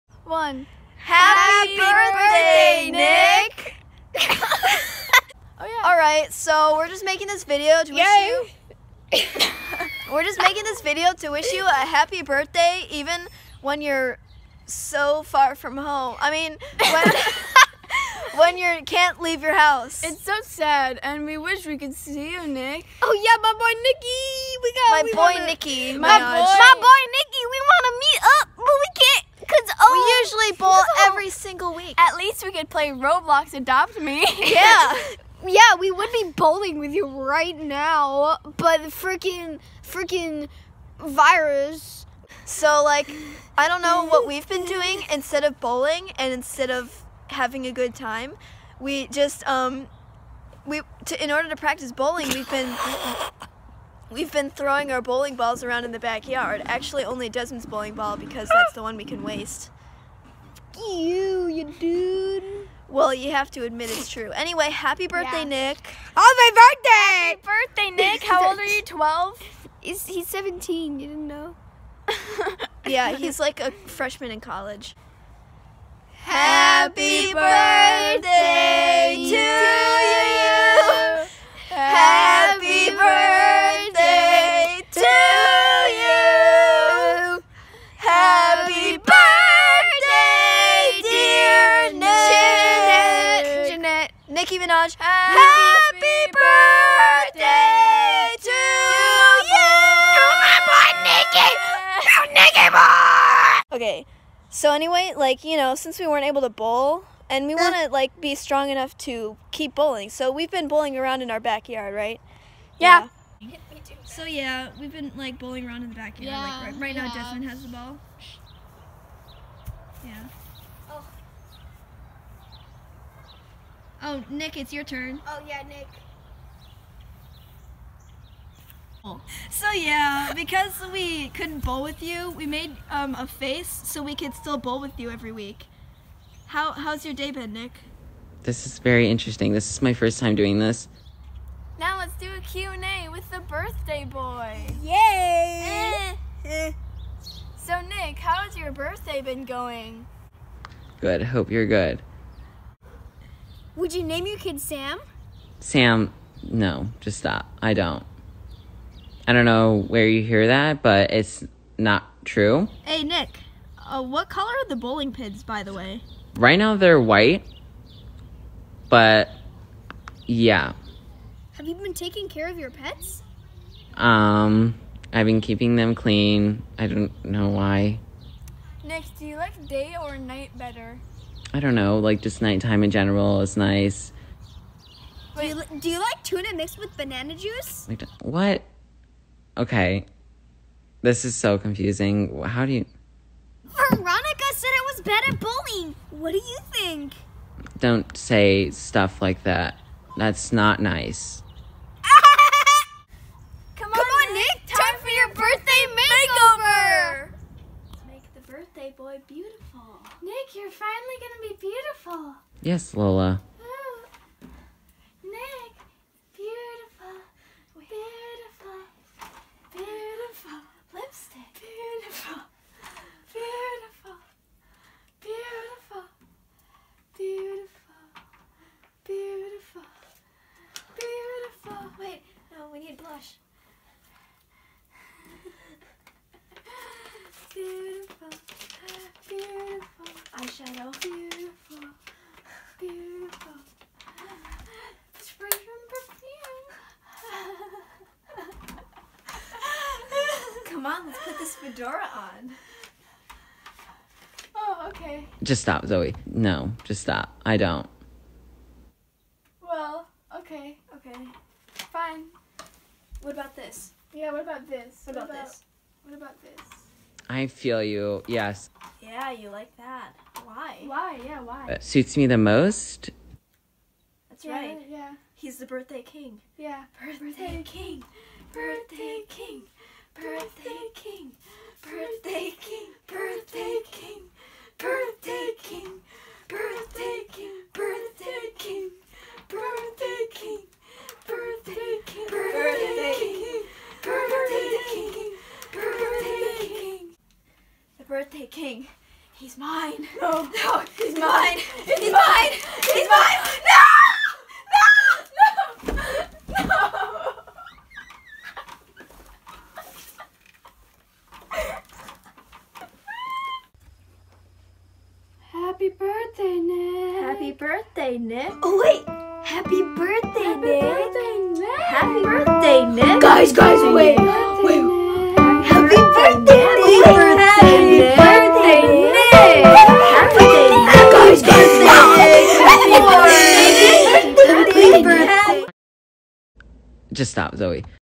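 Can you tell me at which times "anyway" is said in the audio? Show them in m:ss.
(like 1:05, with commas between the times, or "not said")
1:04, 1:44.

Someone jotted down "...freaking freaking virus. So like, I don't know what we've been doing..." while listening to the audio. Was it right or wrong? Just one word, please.
right.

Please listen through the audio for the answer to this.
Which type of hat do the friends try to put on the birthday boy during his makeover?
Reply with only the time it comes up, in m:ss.
4:11.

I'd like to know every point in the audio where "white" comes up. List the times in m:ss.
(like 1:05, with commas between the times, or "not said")
2:46.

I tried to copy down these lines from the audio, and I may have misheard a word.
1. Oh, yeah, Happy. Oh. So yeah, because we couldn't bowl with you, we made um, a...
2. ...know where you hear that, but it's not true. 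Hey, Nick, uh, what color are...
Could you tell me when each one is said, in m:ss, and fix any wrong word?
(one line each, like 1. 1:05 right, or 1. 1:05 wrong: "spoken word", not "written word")
1. 2:05 wrong: "Nick", not "Happy"
2. 2:39 right.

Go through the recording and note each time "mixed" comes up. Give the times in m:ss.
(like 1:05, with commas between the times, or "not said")
3:06.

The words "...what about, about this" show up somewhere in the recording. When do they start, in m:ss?
4:25.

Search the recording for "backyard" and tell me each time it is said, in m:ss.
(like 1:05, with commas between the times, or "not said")
0:55, 1:51, 1:55.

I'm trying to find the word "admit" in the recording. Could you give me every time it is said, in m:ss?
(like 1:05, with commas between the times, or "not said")
1:03.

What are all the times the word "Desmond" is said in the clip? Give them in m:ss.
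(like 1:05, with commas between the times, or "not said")
0:57, 1:57.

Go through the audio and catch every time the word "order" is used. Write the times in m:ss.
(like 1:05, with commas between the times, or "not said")
0:51.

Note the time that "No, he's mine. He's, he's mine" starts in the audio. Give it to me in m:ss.
5:00.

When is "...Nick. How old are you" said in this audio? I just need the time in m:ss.
1:08.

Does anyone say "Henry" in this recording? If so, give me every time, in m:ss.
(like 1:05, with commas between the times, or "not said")
not said.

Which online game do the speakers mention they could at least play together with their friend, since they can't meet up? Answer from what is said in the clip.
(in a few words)
Roblox Adopt Me.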